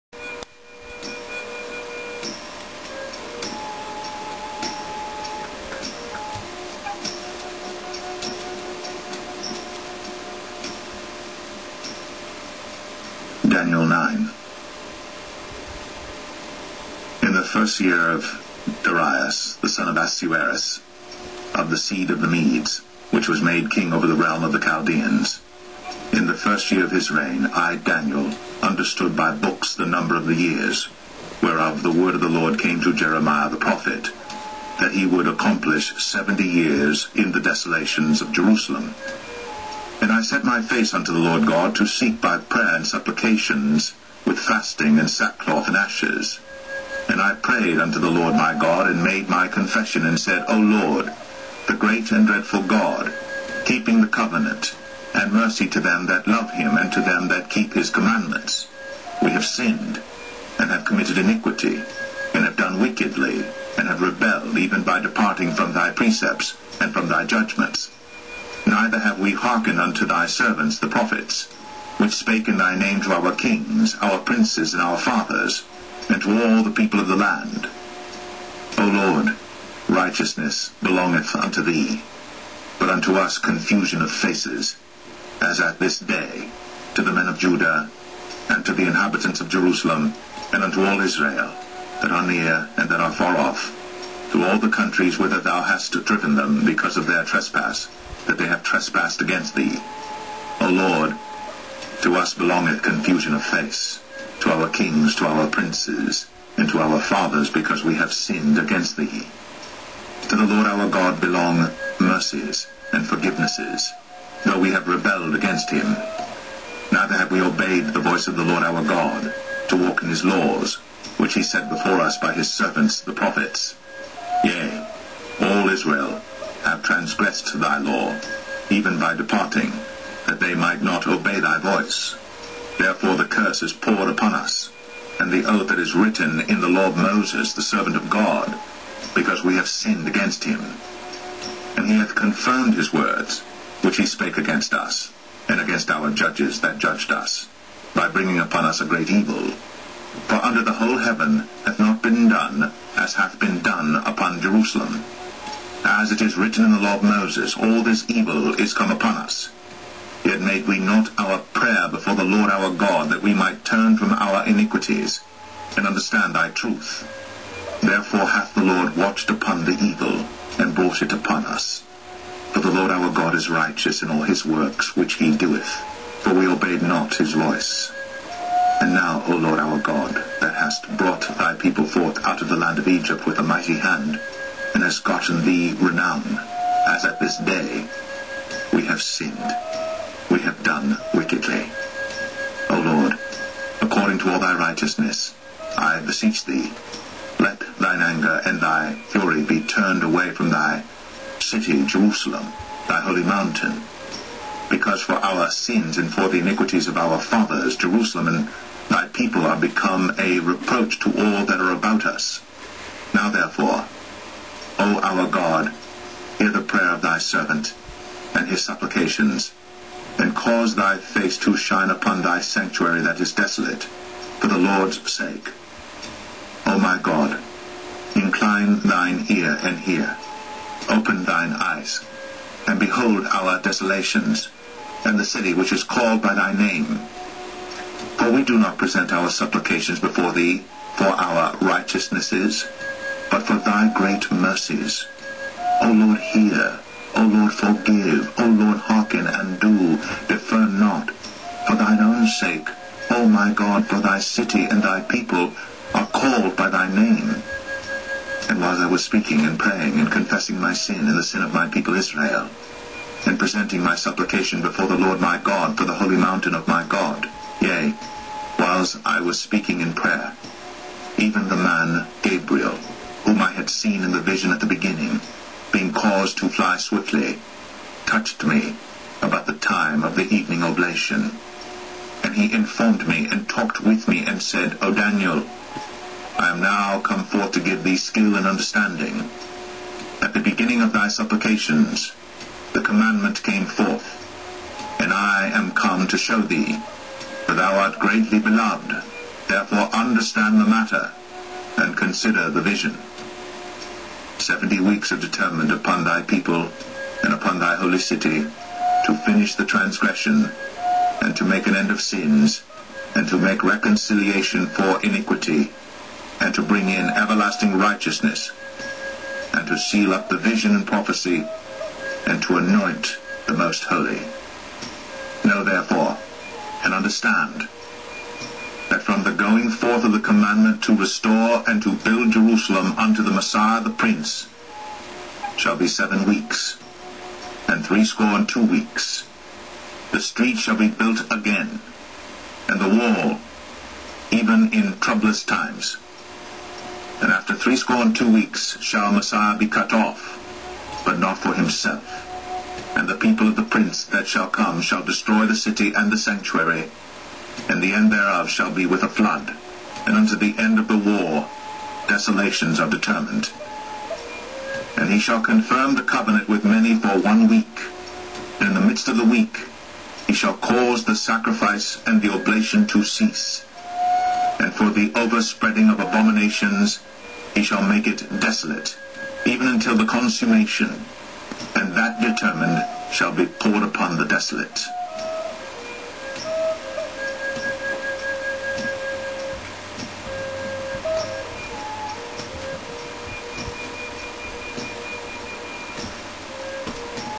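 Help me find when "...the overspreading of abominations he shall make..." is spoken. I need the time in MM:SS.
06:14.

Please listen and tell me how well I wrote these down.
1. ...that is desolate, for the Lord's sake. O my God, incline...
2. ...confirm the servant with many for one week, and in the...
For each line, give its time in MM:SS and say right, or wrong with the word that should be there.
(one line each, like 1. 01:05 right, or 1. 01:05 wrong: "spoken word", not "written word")
1. 03:43 right
2. 06:05 wrong: "covenant", not "servant".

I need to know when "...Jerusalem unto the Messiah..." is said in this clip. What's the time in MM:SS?
05:32.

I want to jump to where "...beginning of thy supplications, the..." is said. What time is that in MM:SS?
04:50.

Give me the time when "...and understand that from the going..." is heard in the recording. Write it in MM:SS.
05:26.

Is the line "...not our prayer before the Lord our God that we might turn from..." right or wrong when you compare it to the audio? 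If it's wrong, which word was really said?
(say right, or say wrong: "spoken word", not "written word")
right.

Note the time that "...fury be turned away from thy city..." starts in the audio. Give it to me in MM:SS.
03:19.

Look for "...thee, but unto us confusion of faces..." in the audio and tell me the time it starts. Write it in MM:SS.
01:21.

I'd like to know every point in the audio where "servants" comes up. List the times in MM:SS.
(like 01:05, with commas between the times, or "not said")
01:10, 02:02, 02:17, 03:37.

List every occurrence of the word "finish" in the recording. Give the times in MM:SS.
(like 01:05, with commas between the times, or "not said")
05:09.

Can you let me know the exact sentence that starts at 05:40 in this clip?
The street shall be built again, and the wall, even in troublous times.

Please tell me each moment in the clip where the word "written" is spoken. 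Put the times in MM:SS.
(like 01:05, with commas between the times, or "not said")
02:15, 02:36.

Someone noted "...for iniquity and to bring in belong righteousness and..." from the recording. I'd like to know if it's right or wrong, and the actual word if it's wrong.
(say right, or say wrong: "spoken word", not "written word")
wrong: "everlasting", not "belong".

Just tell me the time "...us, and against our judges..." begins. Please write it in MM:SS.
02:24.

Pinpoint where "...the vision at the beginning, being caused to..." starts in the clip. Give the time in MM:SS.
04:34.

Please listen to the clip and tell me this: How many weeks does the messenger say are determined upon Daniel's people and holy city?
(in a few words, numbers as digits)
70.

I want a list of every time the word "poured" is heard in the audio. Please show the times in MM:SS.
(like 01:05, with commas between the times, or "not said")
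02:13, 06:23.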